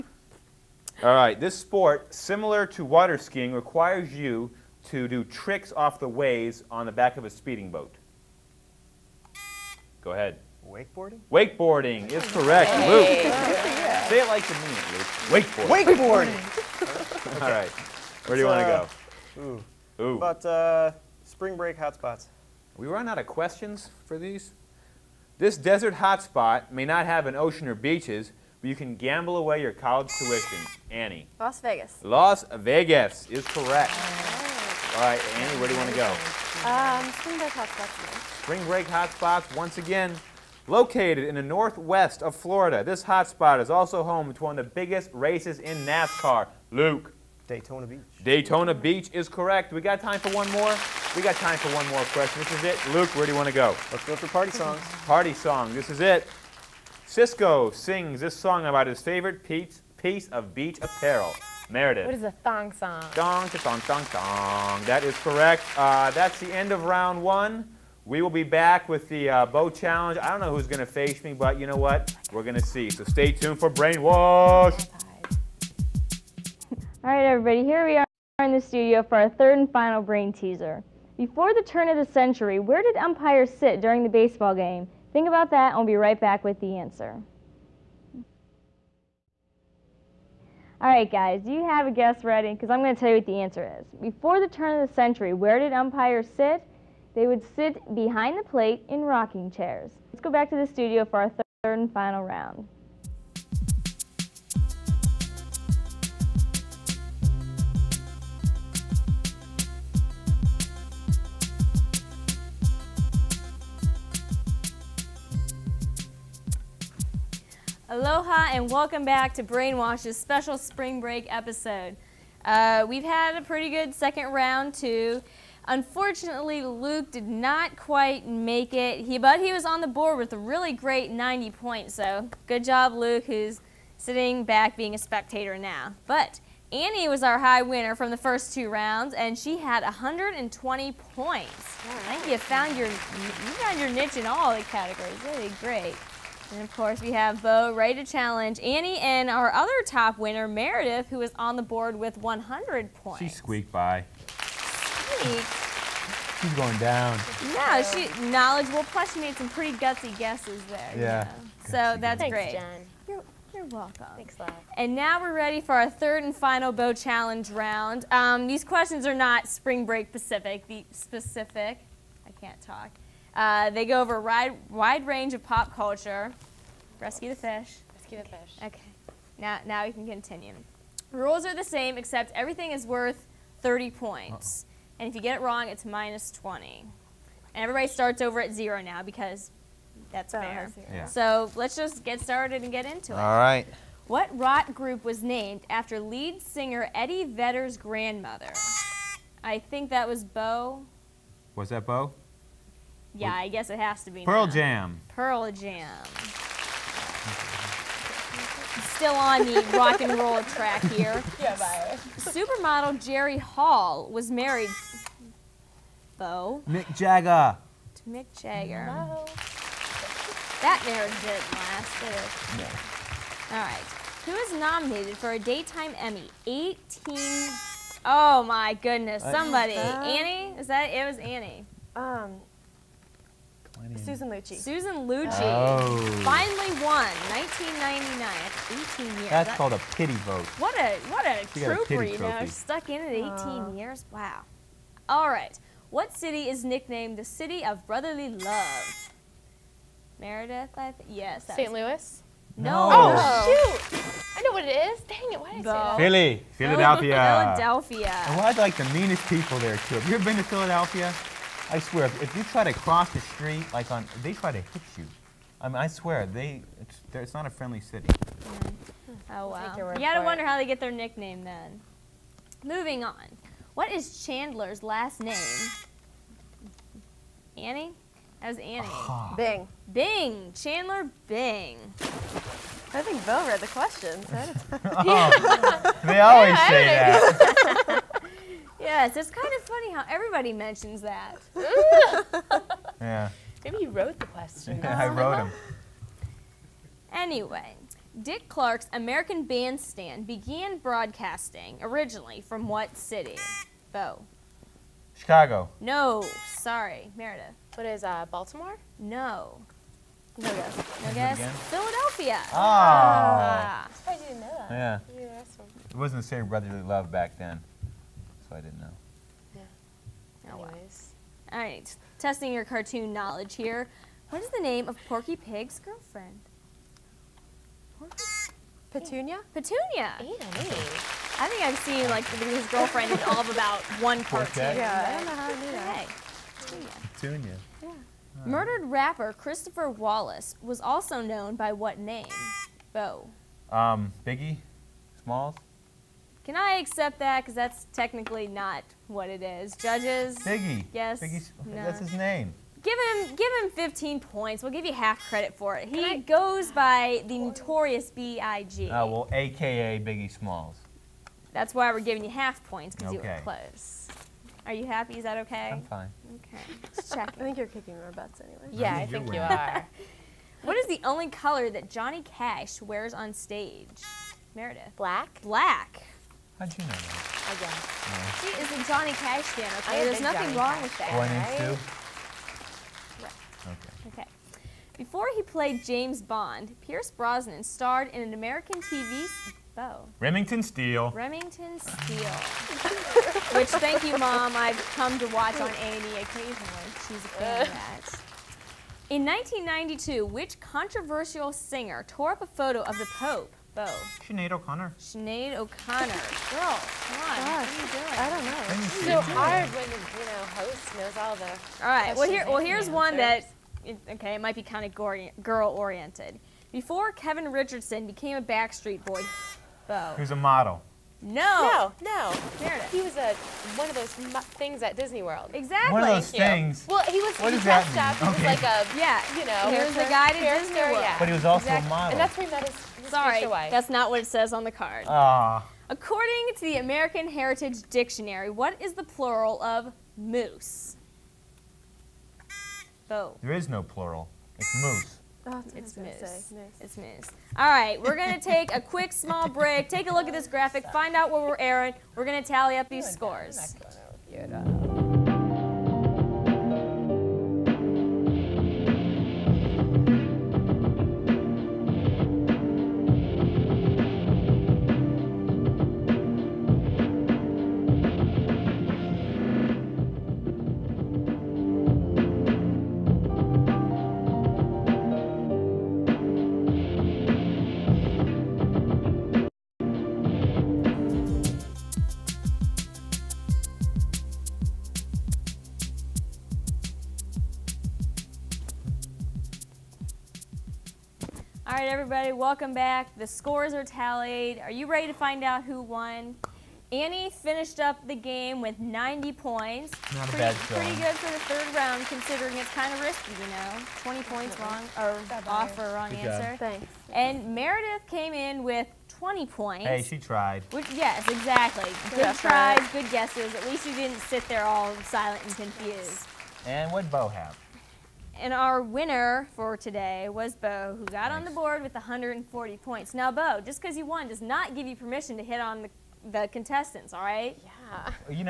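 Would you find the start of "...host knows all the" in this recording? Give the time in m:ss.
6:50.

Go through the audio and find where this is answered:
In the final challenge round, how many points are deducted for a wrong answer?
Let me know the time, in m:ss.
3:05.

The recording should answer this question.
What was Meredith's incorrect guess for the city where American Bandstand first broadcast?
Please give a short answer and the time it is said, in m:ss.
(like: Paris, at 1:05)
Baltimore, at 5:08.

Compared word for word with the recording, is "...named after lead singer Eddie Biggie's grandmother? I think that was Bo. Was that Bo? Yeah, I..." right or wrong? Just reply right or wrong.
wrong.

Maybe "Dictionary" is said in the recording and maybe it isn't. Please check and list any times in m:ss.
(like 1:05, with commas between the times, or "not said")
7:17.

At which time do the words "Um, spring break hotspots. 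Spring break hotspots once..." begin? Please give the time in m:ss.
0:36.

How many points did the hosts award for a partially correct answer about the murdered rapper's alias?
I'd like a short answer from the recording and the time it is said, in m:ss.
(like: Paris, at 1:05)
15, at 5:53.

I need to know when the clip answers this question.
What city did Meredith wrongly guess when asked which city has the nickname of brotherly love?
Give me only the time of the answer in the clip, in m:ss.
4:11.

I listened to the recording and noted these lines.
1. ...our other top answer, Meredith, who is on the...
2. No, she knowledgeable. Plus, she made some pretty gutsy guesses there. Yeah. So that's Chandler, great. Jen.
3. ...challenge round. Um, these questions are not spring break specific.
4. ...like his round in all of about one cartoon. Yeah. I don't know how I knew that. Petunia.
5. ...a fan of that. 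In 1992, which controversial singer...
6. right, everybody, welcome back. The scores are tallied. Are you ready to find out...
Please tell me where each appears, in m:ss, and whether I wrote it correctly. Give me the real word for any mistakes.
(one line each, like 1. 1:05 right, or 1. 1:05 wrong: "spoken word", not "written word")
1. 2:29 wrong: "winner", not "answer"
2. 2:37 wrong: "Thanks", not "Chandler"
3. 2:46 right
4. 5:32 wrong: "girlfriend", not "round"
5. 6:37 right
6. 8:11 right.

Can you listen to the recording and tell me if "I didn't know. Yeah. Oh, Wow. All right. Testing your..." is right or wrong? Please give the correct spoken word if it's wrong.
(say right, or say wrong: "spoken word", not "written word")
right.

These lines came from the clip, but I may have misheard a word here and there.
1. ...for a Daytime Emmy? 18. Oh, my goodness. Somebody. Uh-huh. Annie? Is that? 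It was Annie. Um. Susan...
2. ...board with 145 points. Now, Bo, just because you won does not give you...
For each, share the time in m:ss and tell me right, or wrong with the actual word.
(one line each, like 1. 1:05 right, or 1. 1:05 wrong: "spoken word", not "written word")
1. 3:45 right
2. 8:41 wrong: "140", not "145".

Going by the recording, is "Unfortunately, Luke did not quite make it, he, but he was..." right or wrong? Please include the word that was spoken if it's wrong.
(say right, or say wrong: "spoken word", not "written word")
right.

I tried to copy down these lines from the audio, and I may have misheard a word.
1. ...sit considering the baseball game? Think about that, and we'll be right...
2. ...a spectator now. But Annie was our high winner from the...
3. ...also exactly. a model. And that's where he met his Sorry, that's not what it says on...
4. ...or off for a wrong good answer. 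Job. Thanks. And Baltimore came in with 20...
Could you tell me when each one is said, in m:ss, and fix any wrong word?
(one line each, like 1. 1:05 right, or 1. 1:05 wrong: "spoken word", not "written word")
1. 1:23 wrong: "during", not "considering"
2. 2:14 right
3. 7:11 right
4. 8:24 wrong: "Meredith", not "Baltimore".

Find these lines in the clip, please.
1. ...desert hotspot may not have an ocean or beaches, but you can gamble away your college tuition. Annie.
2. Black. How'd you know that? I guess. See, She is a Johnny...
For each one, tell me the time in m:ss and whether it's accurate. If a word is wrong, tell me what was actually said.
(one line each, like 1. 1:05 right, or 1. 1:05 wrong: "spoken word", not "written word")
1. 0:25 right
2. 6:15 right.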